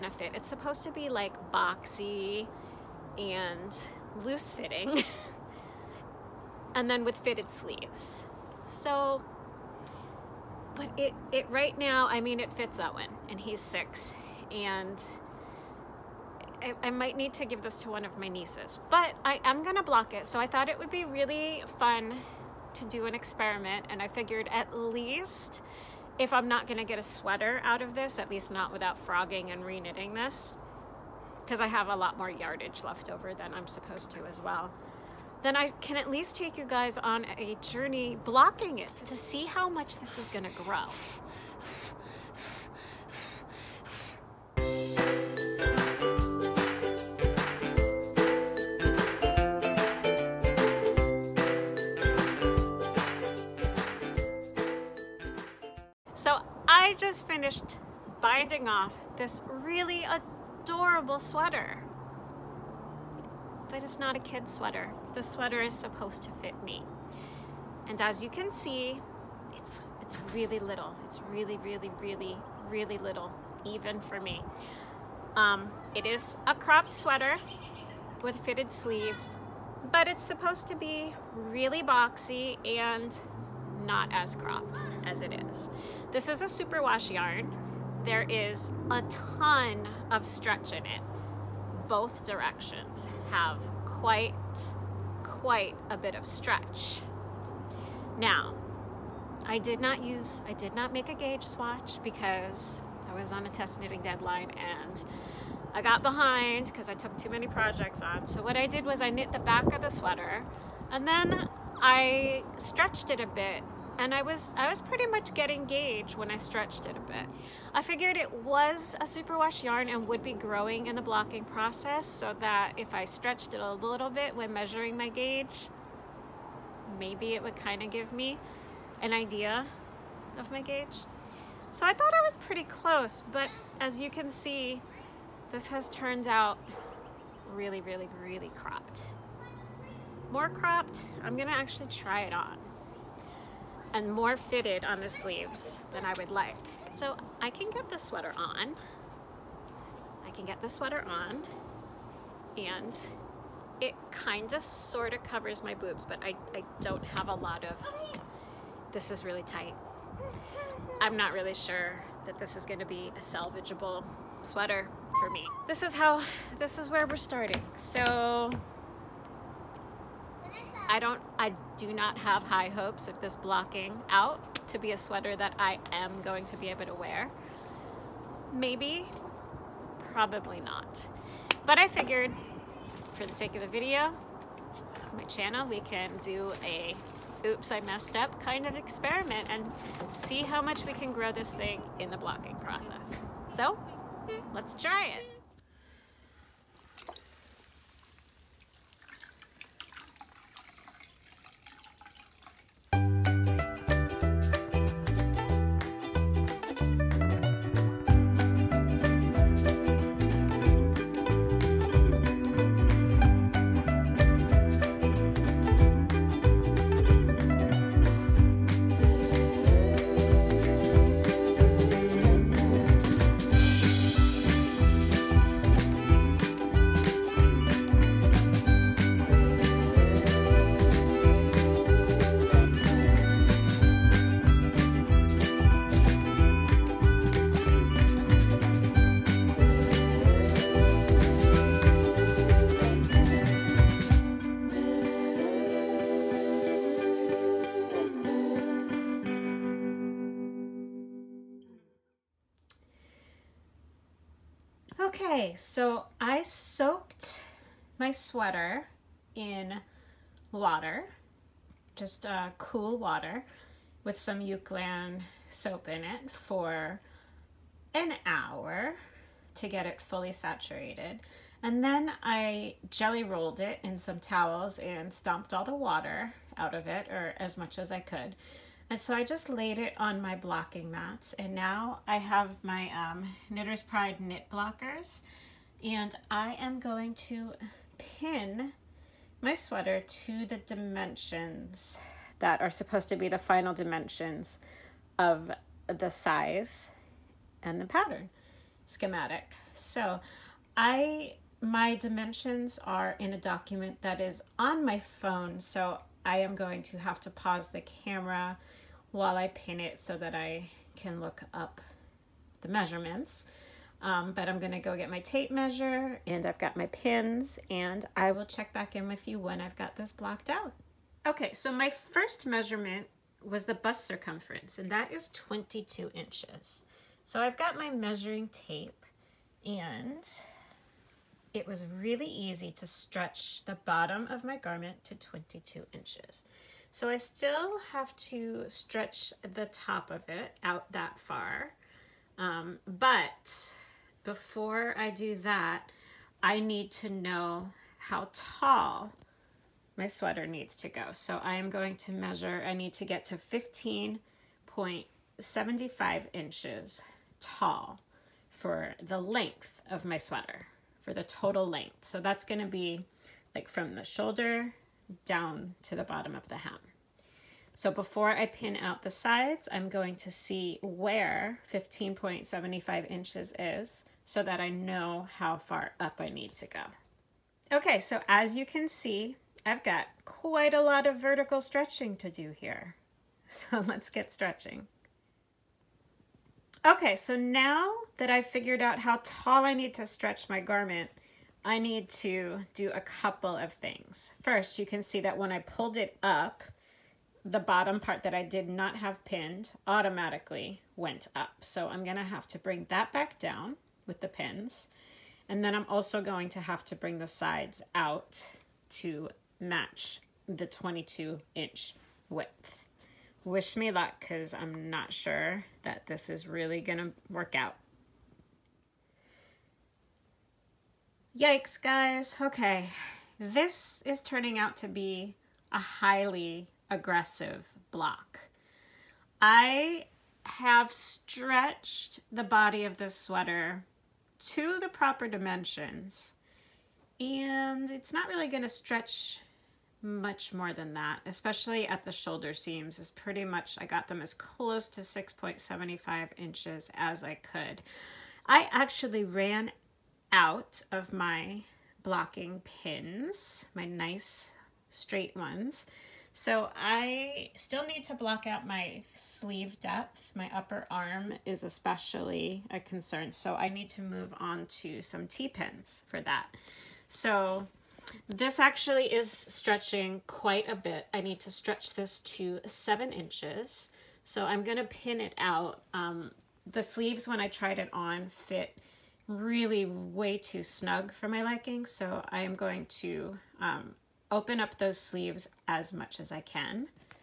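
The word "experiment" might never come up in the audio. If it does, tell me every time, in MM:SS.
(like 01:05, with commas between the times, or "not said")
00:23, 03:08.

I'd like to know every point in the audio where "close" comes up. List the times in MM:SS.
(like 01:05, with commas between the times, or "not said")
02:12, 07:24.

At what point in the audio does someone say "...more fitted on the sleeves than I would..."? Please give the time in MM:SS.
02:24.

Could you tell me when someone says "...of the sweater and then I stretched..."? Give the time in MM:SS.
01:49.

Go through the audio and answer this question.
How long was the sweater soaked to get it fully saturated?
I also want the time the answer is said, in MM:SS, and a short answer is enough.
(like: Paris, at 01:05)
an hour, at 04:27.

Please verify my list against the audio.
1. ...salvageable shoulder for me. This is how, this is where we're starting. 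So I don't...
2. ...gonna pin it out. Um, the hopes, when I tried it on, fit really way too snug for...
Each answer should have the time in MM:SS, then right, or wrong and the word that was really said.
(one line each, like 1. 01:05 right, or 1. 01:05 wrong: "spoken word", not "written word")
1. 02:43 wrong: "sweater", not "shoulder"
2. 07:54 wrong: "sleeves", not "hopes".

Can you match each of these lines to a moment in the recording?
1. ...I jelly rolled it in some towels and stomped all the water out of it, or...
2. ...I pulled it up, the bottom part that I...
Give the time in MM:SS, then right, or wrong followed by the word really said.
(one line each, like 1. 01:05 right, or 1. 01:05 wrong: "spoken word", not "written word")
1. 04:32 right
2. 06:35 right.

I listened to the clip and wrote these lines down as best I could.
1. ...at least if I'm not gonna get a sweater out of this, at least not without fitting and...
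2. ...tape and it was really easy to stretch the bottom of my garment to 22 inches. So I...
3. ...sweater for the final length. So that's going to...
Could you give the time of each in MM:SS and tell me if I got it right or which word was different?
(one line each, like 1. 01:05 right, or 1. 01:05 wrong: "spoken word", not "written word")
1. 00:24 wrong: "frogging", not "fitting"
2. 05:28 right
3. 06:00 wrong: "total", not "final".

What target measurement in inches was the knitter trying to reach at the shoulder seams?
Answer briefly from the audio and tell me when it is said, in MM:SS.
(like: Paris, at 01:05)
6.75 inches, at 07:25.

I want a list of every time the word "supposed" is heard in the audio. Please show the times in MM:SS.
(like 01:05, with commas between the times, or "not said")
00:00, 00:33, 01:05, 01:20, 04:52.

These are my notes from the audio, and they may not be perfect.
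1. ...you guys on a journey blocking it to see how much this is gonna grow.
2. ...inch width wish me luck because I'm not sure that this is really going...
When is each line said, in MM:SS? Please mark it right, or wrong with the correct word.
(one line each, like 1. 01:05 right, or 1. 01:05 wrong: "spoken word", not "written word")
1. 00:36 right
2. 06:51 right.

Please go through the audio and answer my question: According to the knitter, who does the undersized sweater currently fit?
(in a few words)
Owen.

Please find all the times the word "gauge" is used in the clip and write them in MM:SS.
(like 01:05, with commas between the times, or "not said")
01:41, 01:55, 02:05, 02:10.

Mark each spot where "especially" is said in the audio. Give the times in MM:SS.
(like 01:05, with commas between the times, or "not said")
07:21, 07:41.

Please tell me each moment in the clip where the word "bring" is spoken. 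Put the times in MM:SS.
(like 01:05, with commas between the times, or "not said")
06:42, 06:46.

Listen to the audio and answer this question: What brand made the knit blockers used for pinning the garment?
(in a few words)
Knitter's Pride.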